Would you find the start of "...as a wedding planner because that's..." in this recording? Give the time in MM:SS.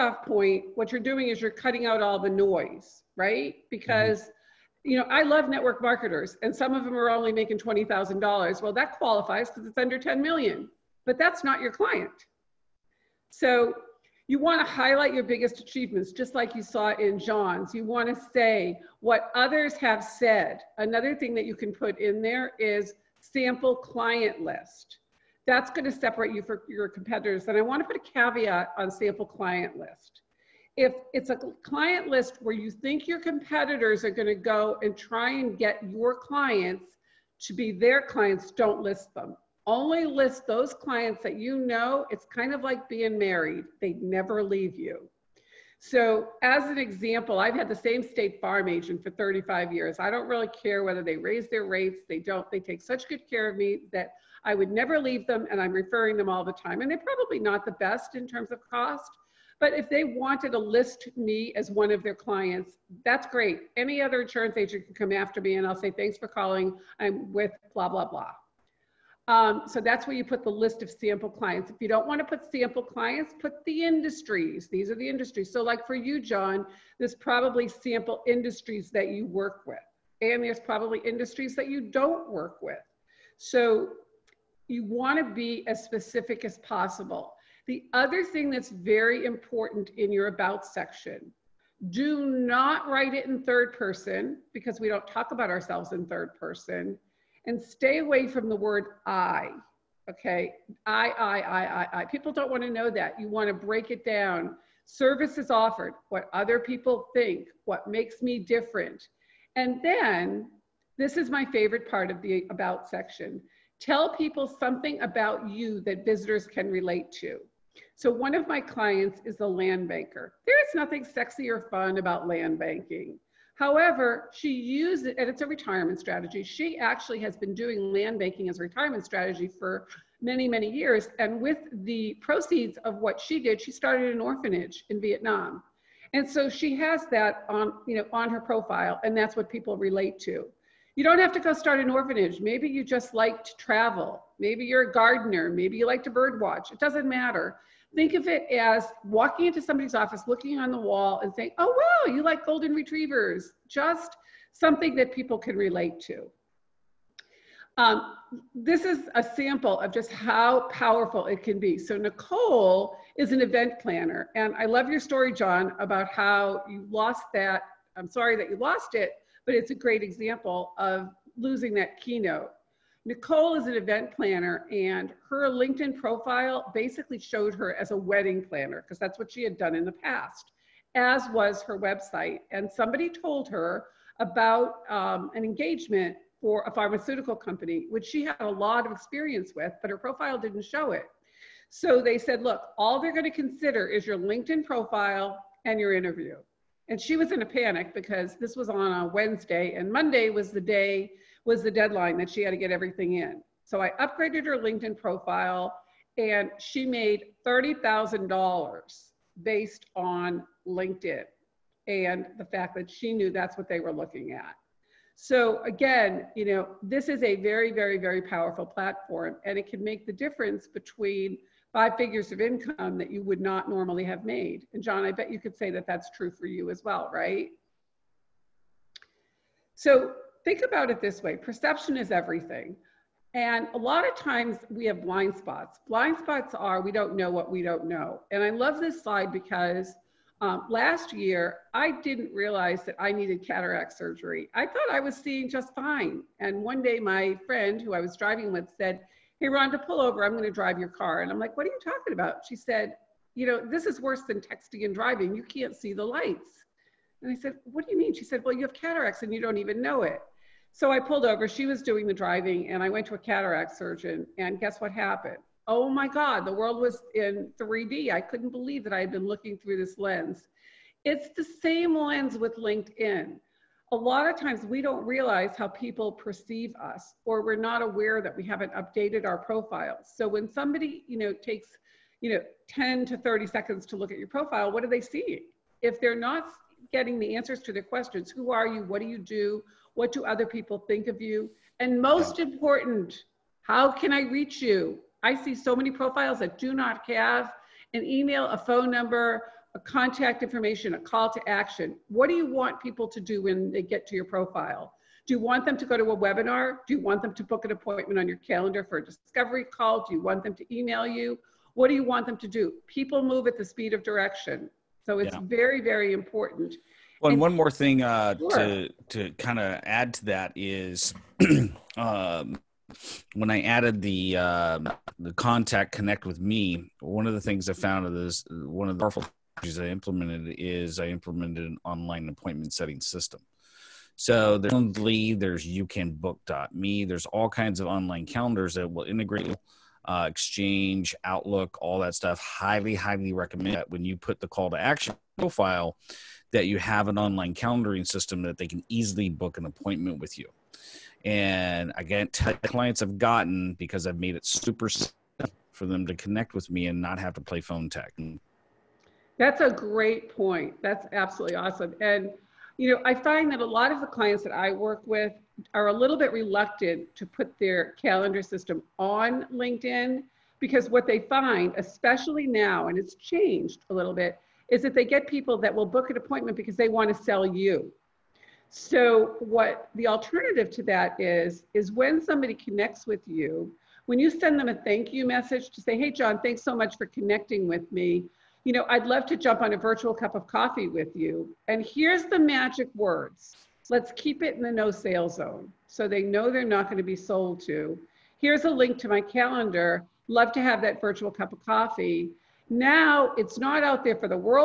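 02:57.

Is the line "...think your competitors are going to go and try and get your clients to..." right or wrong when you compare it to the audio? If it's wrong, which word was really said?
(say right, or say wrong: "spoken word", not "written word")
right.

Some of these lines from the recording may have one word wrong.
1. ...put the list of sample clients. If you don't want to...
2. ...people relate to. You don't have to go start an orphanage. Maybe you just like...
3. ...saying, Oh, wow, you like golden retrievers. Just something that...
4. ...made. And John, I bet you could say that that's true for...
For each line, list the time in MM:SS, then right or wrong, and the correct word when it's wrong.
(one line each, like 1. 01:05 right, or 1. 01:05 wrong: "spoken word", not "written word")
1. 01:10 right
2. 02:19 right
3. 02:31 right
4. 03:44 right.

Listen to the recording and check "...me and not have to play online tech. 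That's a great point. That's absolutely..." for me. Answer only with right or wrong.
wrong.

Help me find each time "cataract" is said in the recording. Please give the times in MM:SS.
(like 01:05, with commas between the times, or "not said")
04:03, 04:18, 04:23.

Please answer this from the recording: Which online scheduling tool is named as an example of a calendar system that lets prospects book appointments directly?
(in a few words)
YouCanBook.me.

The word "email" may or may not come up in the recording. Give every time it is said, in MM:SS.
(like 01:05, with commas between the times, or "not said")
04:58, 05:10.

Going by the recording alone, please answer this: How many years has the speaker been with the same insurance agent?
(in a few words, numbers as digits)
35.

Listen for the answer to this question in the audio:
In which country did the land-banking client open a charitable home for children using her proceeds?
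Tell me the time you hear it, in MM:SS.
02:15.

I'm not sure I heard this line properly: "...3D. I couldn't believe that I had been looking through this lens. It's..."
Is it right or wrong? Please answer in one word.
right.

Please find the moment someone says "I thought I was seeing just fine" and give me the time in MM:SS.
04:04.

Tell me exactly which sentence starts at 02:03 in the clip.
However, she uses it, and it's a retirement strategy.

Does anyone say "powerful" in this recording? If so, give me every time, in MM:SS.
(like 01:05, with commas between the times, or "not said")
02:40, 03:38, 05:29.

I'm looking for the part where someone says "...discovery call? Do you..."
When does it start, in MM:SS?
05:09.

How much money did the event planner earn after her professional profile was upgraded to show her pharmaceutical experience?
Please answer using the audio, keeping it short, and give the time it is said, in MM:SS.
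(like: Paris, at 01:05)
$30,000, at 03:27.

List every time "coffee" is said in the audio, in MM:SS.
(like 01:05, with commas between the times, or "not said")
06:30, 06:41.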